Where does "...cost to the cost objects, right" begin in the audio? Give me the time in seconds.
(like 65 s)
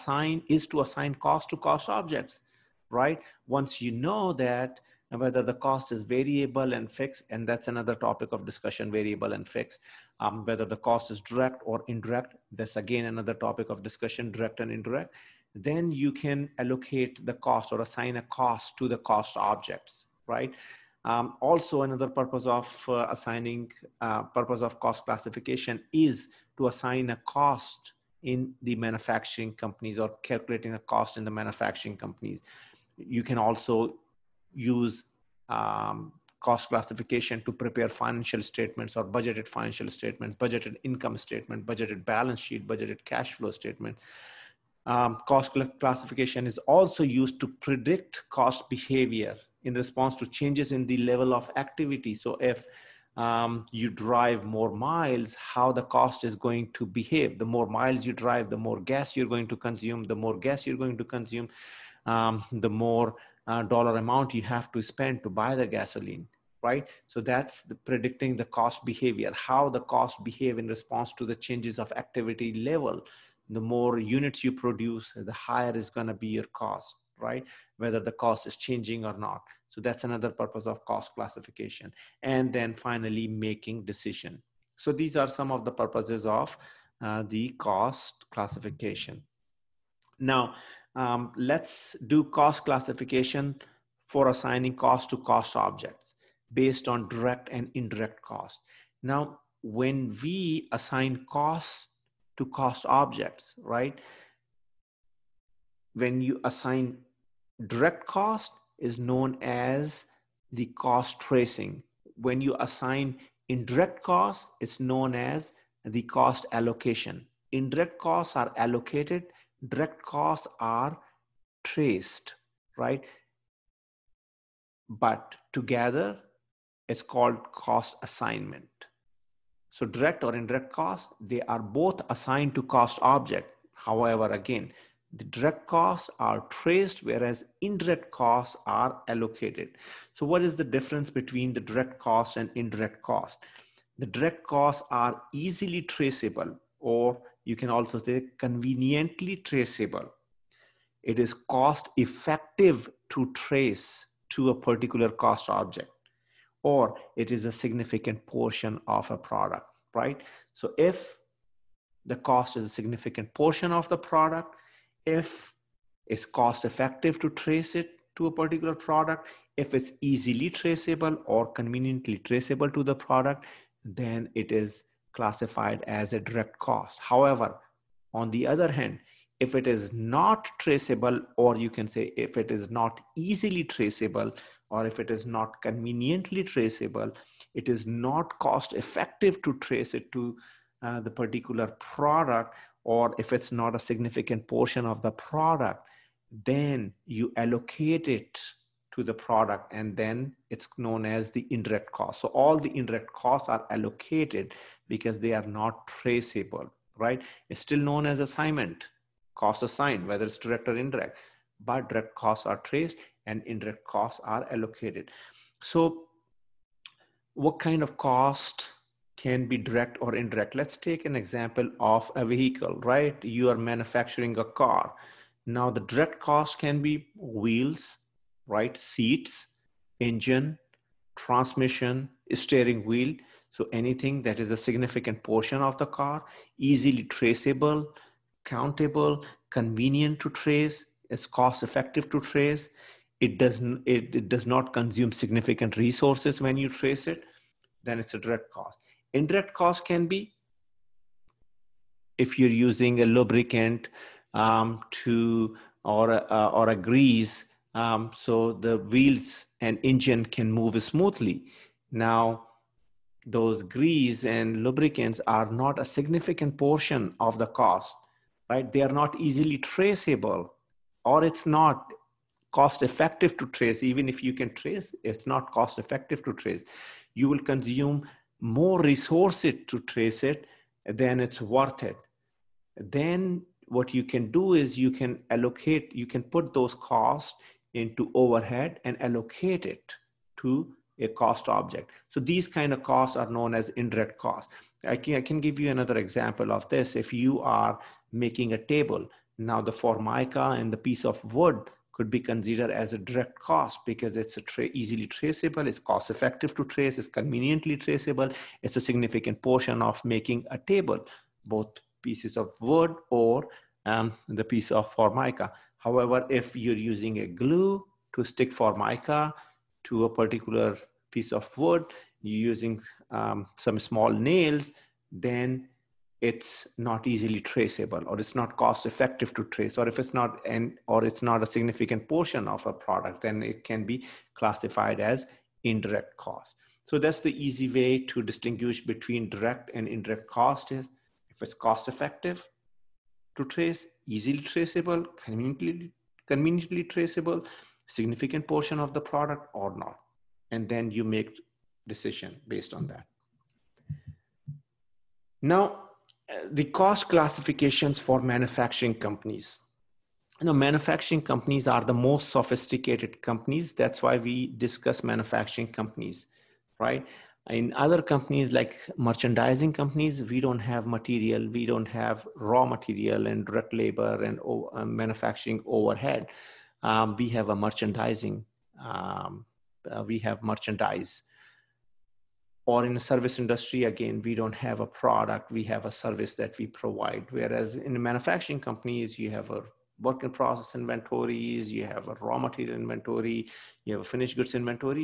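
18 s.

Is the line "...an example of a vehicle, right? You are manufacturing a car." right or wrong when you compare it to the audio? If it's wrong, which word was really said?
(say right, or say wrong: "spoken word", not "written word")
right.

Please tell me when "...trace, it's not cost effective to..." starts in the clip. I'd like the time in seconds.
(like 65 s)
274 s.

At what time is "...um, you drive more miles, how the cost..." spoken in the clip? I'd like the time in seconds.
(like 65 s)
53 s.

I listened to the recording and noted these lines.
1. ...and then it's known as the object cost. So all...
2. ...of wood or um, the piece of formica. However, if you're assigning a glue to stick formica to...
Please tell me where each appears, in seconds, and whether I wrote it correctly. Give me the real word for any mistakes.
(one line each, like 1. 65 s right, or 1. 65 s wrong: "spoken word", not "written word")
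1. 199 s wrong: "indirect", not "object"
2. 312 s wrong: "using", not "assigning".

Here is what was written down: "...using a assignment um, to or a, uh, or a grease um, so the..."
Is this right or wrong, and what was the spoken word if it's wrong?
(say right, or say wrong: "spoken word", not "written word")
wrong: "lubricant", not "assignment".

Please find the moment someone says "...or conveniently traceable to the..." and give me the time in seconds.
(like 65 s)
171 s.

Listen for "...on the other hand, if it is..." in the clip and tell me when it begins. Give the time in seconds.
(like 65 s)
178 s.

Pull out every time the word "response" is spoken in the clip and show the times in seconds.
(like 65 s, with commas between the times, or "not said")
49 s, 70 s.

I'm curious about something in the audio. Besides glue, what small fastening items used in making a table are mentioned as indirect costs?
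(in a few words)
small nails.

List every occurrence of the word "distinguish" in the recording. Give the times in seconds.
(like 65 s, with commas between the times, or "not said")
338 s.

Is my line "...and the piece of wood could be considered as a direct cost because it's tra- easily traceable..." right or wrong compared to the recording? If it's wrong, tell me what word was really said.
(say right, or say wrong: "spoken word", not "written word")
right.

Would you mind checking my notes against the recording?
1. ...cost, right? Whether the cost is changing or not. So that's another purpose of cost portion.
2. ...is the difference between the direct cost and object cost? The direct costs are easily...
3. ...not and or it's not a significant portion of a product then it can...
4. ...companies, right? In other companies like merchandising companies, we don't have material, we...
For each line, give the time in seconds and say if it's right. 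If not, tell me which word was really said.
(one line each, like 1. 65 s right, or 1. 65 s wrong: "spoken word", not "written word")
1. 76 s wrong: "classification", not "portion"
2. 140 s wrong: "indirect", not "object"
3. 330 s right
4. 365 s right.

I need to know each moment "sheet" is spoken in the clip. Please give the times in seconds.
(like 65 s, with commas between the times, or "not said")
42 s.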